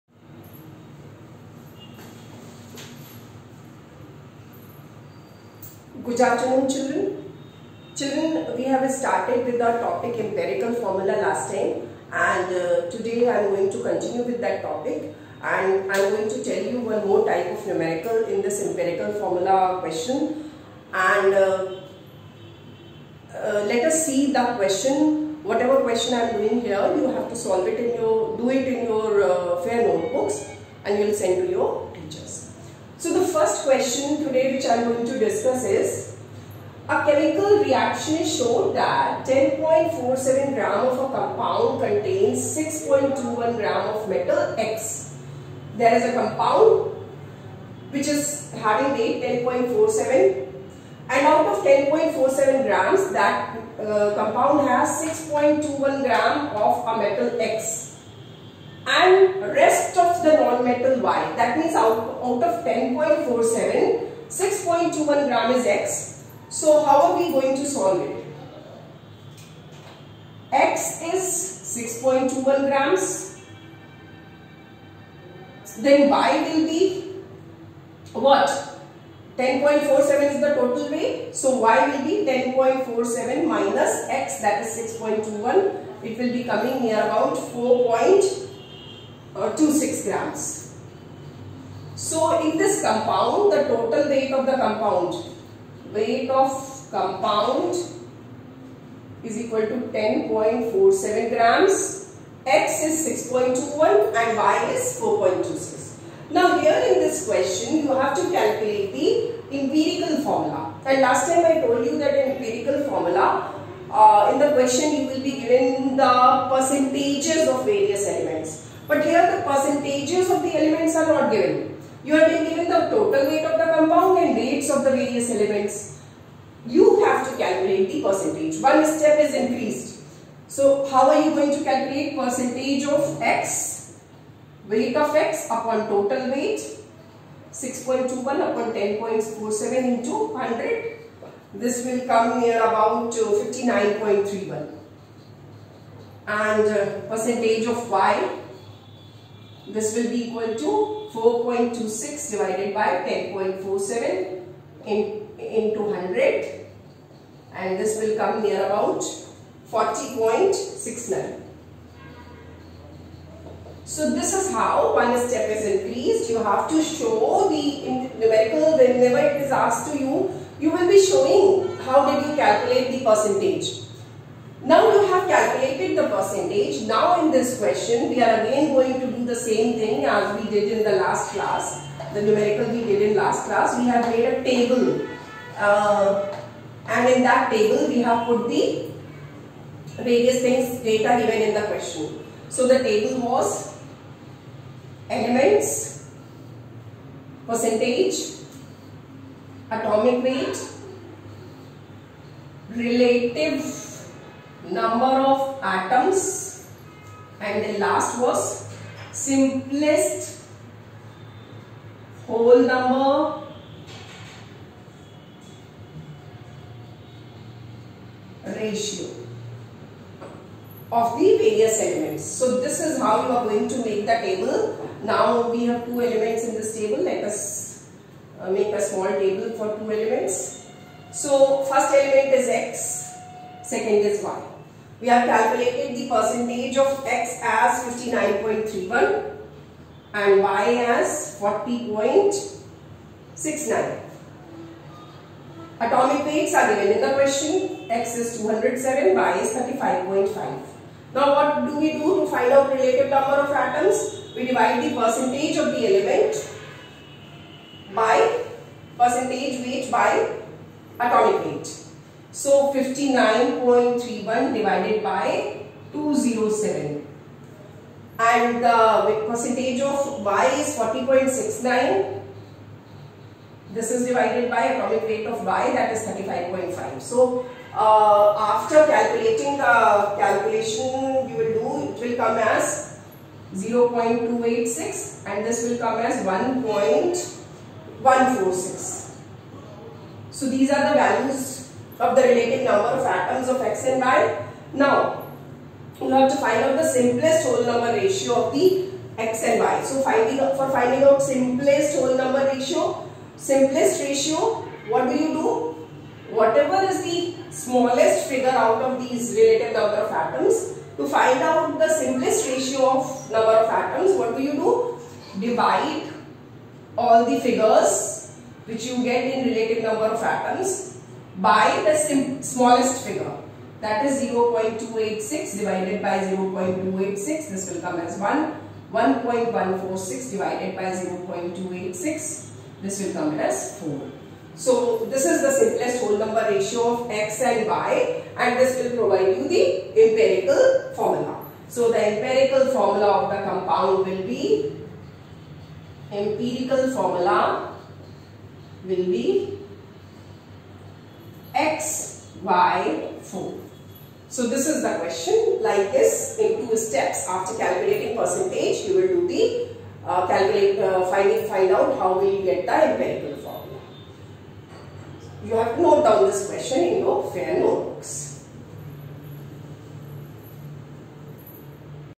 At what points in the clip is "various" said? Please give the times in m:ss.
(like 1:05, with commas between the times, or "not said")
1:57, 2:04, 3:10, 3:41.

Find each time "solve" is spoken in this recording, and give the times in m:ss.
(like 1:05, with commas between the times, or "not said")
0:27, 1:07.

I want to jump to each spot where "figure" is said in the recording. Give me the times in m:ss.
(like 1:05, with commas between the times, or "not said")
5:08, 5:17, 5:23.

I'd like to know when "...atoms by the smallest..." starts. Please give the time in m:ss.
5:20.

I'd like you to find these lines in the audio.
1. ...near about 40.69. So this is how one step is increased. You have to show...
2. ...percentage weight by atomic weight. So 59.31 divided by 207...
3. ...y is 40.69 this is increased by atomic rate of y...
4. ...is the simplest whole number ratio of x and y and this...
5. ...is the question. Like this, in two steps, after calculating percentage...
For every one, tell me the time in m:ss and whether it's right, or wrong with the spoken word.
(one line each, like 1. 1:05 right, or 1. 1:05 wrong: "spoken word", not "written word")
1. 2:38 right
2. 4:18 right
3. 4:30 wrong: "divided", not "increased"
4. 5:35 right
5. 5:54 right.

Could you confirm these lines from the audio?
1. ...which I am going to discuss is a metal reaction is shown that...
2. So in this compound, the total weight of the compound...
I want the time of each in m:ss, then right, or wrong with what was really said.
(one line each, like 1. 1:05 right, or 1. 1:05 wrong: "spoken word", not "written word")
1. 0:34 wrong: "chemical", not "metal"
2. 1:32 right.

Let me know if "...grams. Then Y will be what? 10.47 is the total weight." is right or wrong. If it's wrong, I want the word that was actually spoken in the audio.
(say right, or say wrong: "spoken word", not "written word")
right.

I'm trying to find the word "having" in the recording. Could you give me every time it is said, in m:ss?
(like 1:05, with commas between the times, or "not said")
0:48.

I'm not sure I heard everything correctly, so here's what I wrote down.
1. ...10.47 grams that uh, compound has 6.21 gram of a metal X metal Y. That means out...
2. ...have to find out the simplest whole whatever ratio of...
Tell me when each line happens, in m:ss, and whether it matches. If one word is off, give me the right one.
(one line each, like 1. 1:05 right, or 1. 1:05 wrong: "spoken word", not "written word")
1. 0:51 right
2. 4:56 wrong: "number", not "whatever".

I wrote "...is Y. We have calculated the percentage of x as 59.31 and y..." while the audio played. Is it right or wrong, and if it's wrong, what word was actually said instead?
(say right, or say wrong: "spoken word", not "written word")
right.